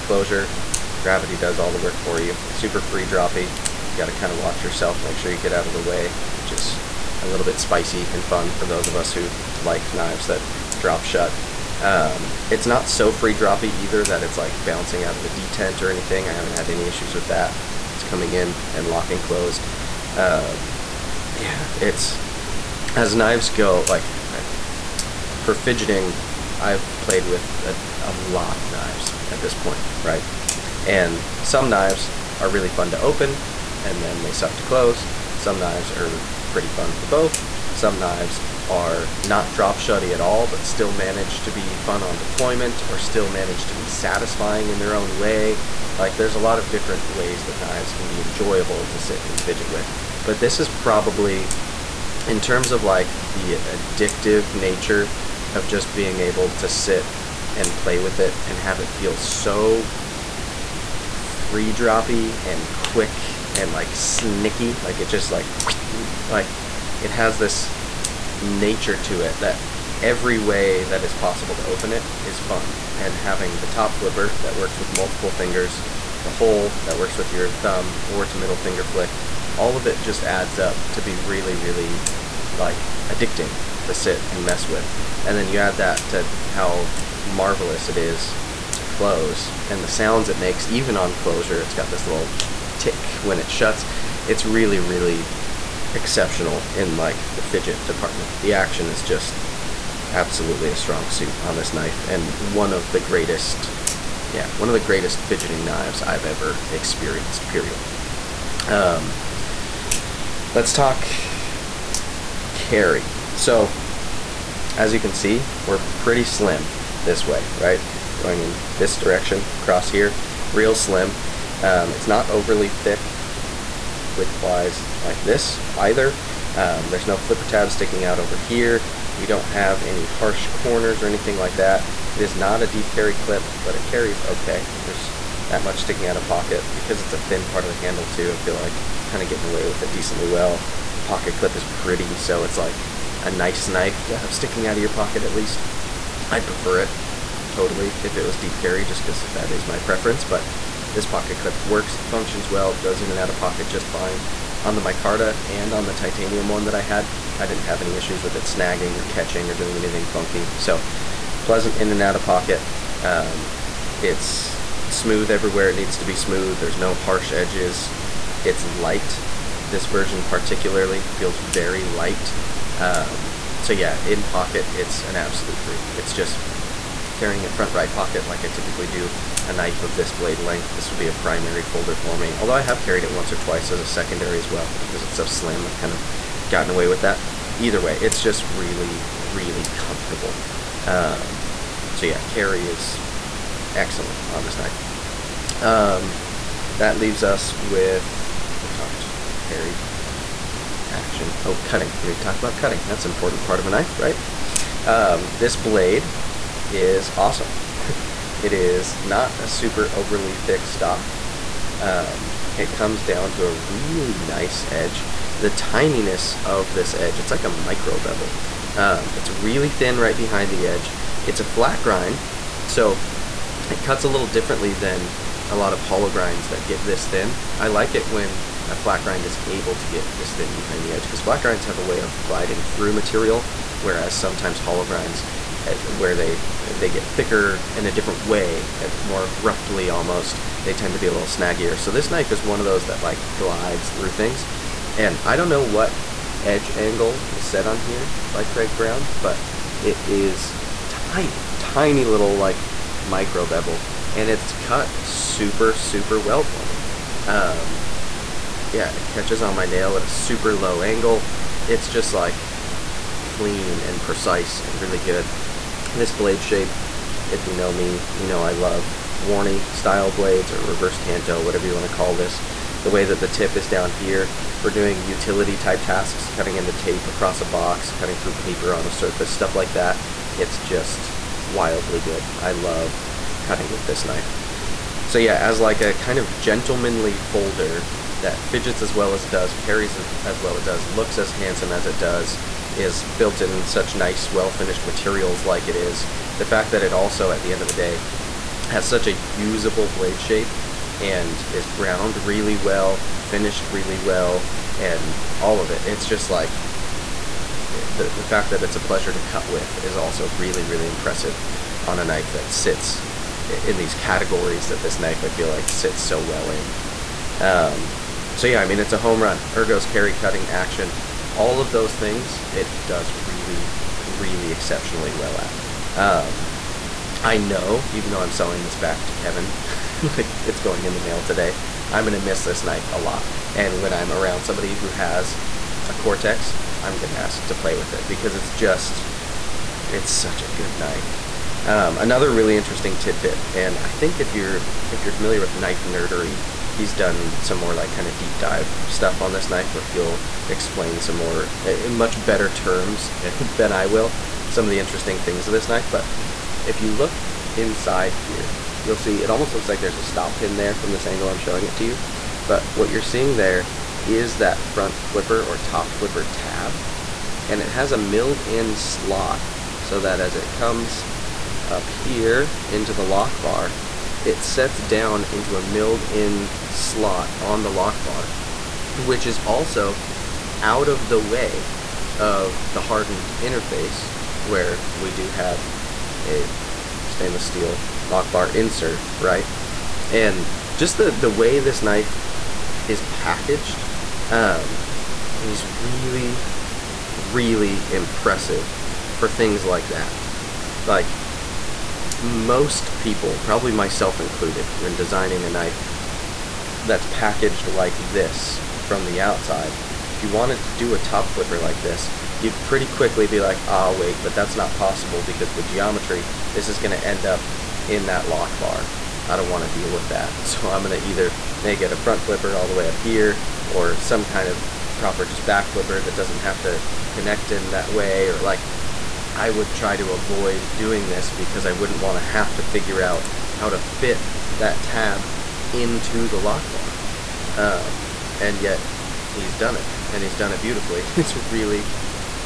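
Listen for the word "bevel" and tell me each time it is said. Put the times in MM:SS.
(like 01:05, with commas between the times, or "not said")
03:37, 04:13.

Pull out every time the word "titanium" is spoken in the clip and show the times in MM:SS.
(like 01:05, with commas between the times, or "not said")
02:35.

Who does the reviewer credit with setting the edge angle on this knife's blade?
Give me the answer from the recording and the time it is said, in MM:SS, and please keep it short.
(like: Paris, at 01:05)
Craig Brown, at 04:08.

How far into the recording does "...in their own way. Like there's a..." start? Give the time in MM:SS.
00:44.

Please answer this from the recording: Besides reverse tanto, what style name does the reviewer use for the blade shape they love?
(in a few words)
Warney.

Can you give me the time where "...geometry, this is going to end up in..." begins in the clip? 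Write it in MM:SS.
06:55.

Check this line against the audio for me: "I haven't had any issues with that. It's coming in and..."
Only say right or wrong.
right.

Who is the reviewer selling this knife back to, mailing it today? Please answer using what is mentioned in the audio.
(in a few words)
Kevin.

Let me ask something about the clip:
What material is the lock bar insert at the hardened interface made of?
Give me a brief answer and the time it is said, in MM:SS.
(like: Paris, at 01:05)
stainless steel, at 06:27.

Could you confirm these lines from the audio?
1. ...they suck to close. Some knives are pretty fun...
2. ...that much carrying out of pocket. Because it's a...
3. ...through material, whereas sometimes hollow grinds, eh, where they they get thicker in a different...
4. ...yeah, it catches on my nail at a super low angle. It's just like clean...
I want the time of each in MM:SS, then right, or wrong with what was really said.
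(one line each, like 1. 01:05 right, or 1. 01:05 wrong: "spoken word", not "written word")
1. 00:34 right
2. 02:15 wrong: "sticking", not "carrying"
3. 03:52 right
4. 04:18 right.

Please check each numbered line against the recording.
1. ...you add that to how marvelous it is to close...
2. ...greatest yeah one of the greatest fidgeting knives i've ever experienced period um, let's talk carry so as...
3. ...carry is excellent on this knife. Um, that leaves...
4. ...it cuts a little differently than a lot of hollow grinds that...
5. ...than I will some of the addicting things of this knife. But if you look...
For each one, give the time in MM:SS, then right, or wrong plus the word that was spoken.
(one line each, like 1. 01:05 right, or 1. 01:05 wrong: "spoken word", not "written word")
1. 01:25 right
2. 01:42 right
3. 03:12 right
4. 03:43 right
5. 05:53 wrong: "interesting", not "addicting".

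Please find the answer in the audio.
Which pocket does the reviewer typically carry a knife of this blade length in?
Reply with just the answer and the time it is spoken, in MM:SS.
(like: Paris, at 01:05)
front right pocket, at 02:57.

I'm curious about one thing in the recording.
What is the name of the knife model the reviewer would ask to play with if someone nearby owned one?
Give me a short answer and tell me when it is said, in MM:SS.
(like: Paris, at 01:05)
Cortex, at 05:35.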